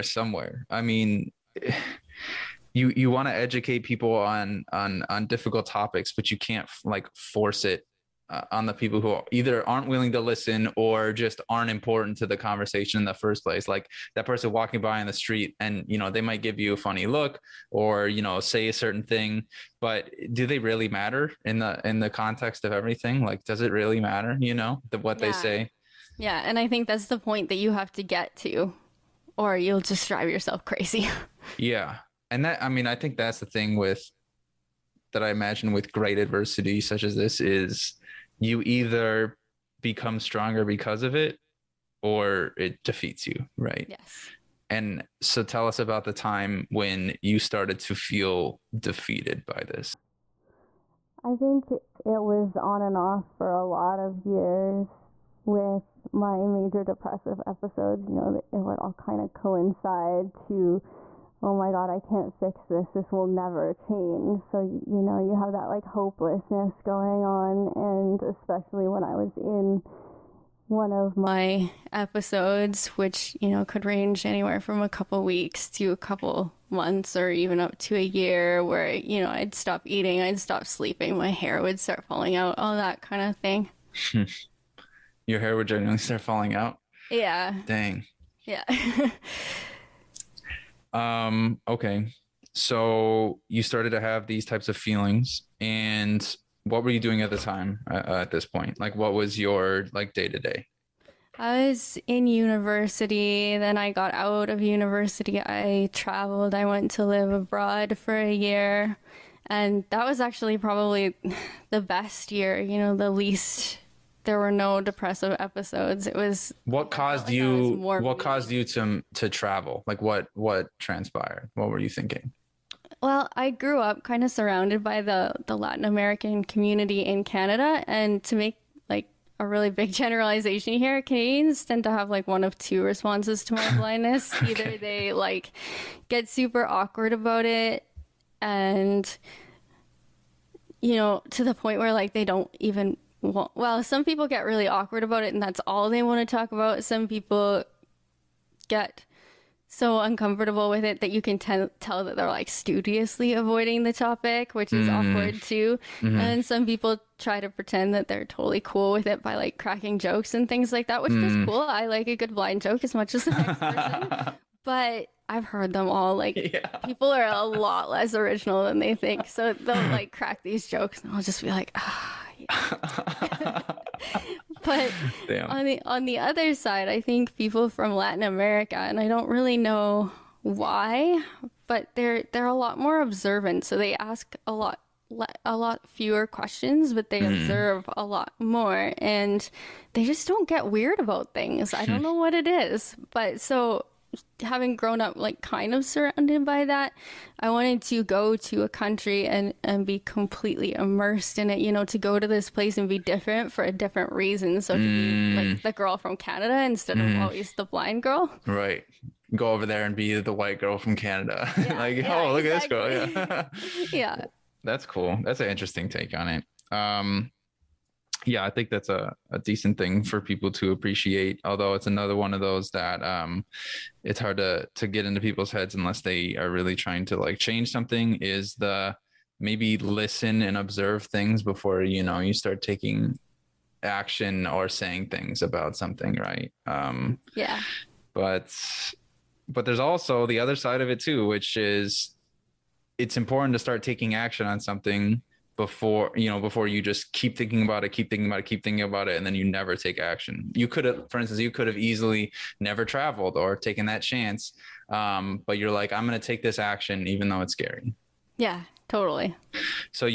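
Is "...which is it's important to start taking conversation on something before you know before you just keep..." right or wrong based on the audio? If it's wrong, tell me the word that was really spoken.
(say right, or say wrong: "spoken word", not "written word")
wrong: "action", not "conversation".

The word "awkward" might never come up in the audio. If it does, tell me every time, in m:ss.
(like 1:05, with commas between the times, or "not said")
2:16, 2:24, 2:34.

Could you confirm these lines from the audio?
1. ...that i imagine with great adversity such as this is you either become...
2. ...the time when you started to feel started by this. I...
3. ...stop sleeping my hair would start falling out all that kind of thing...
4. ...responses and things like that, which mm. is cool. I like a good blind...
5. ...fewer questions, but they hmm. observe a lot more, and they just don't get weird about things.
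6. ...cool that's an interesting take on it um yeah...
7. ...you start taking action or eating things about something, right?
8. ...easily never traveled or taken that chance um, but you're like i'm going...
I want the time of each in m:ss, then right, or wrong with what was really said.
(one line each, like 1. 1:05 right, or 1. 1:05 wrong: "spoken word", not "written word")
1. 0:35 right
2. 0:46 wrong: "defeated", not "started"
3. 1:20 right
4. 2:39 wrong: "jokes", not "responses"
5. 3:05 right
6. 3:34 right
7. 3:52 wrong: "saying", not "eating"
8. 4:11 right.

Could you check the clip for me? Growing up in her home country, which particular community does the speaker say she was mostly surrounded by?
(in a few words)
Latin American community.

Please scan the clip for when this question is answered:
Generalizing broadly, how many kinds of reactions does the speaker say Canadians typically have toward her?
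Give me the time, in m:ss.
2:12.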